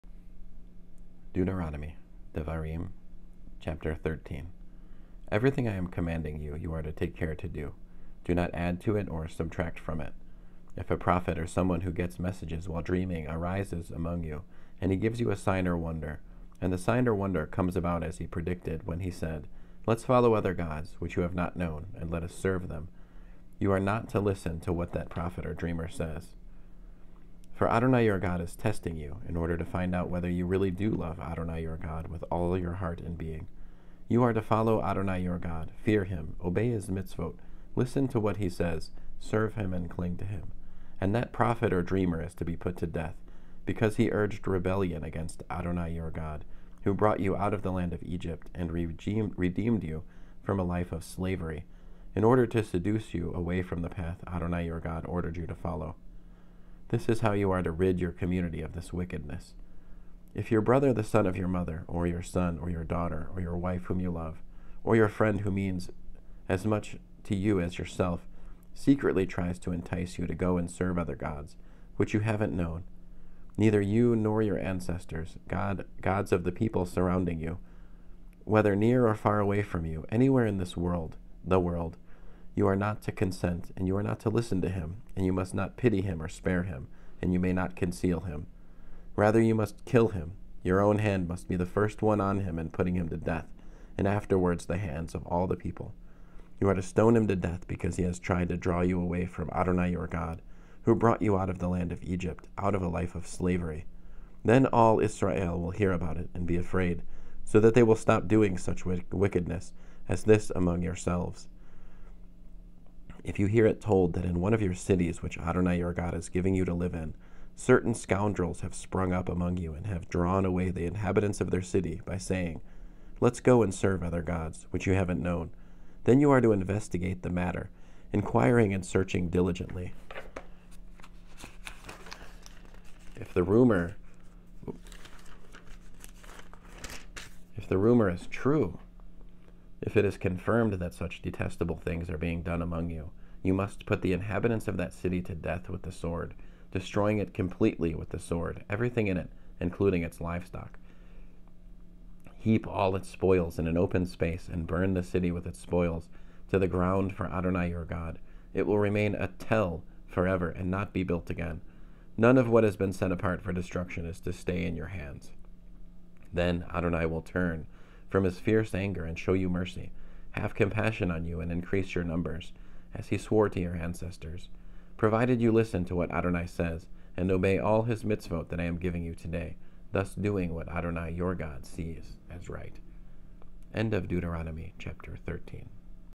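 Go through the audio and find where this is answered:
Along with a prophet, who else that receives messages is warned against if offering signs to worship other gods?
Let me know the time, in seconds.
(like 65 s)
11 s.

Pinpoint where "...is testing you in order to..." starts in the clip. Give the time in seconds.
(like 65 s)
28 s.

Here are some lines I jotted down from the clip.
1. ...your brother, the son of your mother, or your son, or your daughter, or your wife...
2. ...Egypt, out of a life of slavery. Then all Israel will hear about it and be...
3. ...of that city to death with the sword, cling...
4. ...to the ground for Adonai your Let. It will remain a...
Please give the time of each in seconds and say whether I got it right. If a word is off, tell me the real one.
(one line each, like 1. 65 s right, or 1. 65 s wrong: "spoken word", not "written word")
1. 60 s right
2. 102 s right
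3. 144 s wrong: "destroying", not "cling"
4. 156 s wrong: "God", not "Let".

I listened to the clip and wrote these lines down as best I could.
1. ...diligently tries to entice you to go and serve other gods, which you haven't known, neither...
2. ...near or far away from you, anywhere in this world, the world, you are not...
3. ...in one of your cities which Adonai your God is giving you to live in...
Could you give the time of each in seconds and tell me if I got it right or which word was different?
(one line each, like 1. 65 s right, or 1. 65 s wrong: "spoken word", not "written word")
1. 68 s wrong: "secretly", not "diligently"
2. 78 s right
3. 114 s right.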